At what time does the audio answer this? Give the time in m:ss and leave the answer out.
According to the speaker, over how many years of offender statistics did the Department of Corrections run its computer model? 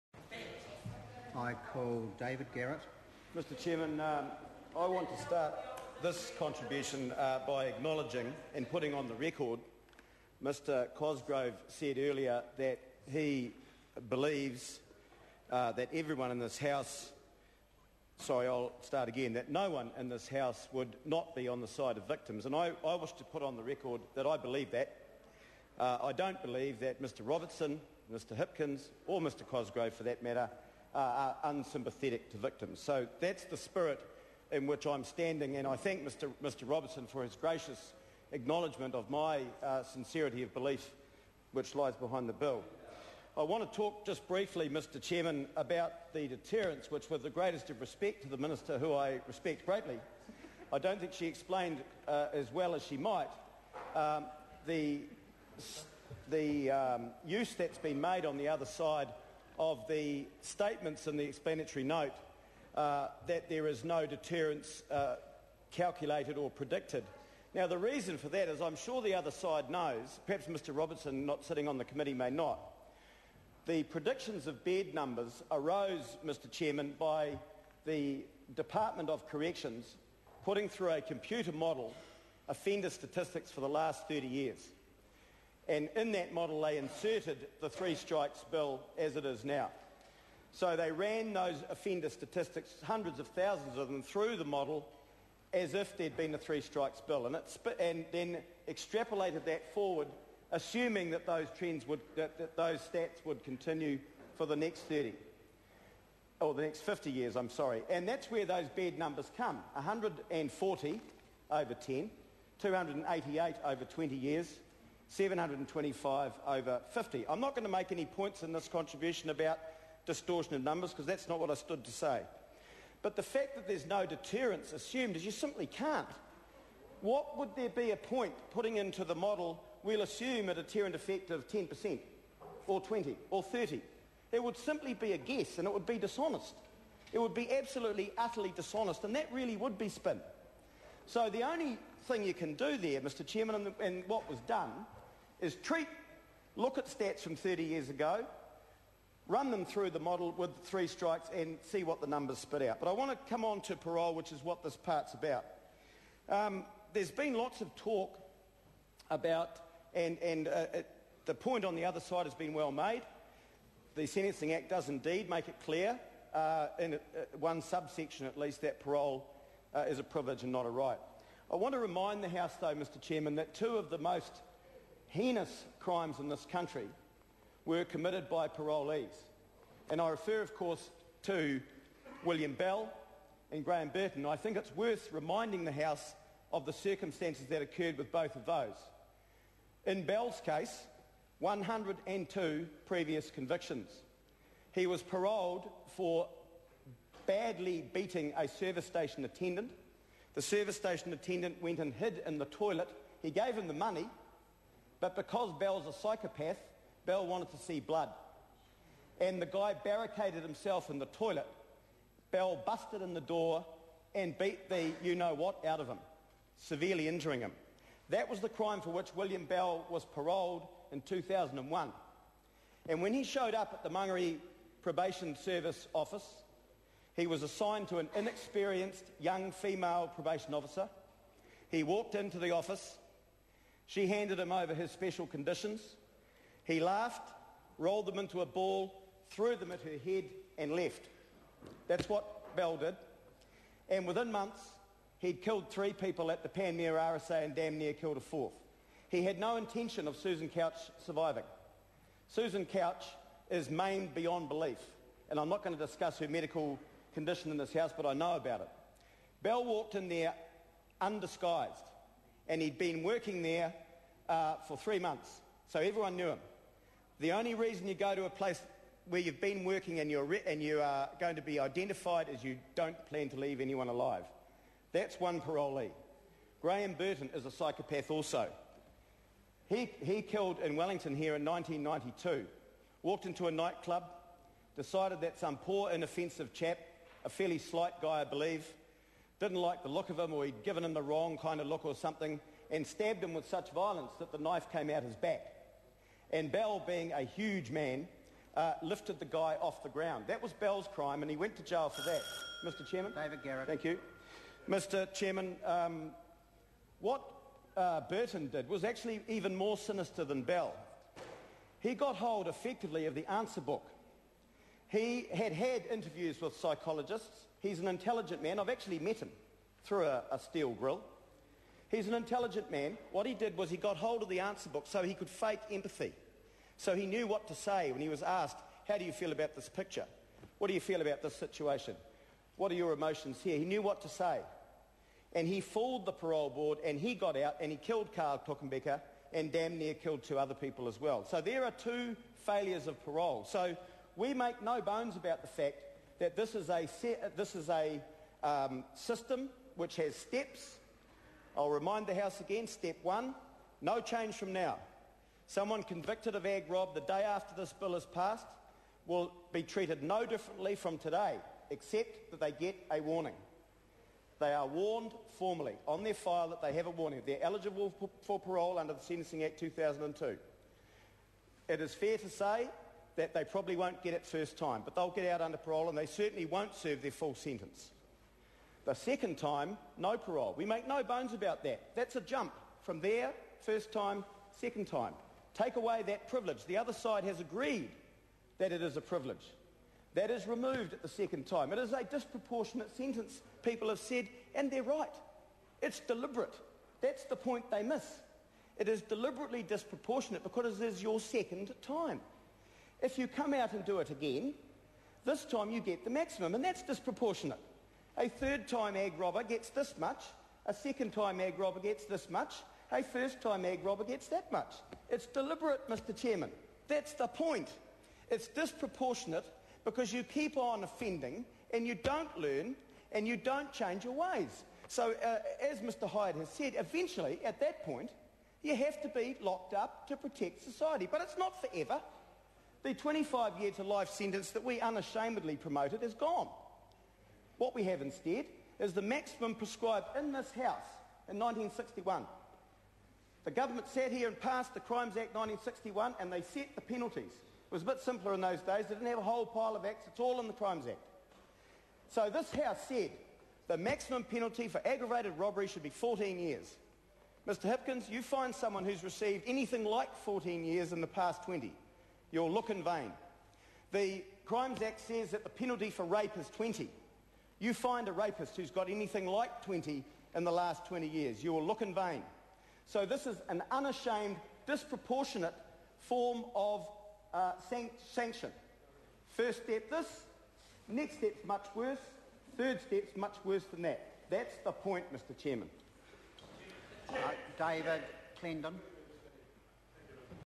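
1:23.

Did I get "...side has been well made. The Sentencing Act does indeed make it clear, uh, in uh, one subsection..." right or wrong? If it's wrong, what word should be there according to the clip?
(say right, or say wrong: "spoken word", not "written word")
right.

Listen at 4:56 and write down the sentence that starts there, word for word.
And Bell, being a huge man, uh, lifted the guy off the ground.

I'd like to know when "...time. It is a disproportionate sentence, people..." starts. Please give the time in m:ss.
6:31.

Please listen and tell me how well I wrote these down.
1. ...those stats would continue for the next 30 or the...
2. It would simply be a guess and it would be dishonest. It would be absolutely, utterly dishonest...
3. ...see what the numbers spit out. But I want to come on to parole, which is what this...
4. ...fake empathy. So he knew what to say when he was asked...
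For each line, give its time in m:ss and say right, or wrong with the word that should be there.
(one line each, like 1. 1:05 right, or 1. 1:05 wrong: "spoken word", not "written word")
1. 1:42 right
2. 2:14 right
3. 2:31 right
4. 5:25 right.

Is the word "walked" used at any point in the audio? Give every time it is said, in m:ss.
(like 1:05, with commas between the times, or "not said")
3:51, 4:19, 4:43.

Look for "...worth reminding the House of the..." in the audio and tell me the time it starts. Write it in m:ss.
3:04.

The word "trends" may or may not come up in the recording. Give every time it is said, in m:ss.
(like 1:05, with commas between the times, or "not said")
1:41.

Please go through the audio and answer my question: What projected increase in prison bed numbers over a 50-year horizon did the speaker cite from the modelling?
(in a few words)
725.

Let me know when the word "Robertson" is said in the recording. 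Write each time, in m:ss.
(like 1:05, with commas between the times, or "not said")
0:27, 0:36, 1:10.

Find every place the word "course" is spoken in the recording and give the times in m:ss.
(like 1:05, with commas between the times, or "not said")
3:00.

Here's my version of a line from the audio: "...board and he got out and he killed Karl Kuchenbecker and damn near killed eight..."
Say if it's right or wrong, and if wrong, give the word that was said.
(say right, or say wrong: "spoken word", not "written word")
wrong: "two", not "eight".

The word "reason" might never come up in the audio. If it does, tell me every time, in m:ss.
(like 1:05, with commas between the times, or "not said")
1:07, 4:27.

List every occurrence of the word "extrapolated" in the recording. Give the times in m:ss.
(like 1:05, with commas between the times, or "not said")
1:38.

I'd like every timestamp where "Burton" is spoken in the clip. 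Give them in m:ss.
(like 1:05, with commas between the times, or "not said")
3:03, 4:36, 5:08.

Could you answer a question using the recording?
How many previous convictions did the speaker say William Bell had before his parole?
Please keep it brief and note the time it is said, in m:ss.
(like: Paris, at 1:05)
102, at 3:11.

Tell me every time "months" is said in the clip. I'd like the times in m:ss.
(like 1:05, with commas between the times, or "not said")
4:04, 4:24.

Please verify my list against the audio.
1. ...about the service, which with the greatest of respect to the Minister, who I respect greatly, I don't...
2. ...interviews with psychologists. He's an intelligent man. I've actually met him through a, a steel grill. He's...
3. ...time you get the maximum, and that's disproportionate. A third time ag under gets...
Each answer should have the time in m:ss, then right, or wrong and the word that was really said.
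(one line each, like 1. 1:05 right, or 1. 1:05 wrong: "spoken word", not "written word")
1. 0:45 wrong: "deterrence", not "service"
2. 5:15 right
3. 6:45 wrong: "robber", not "under".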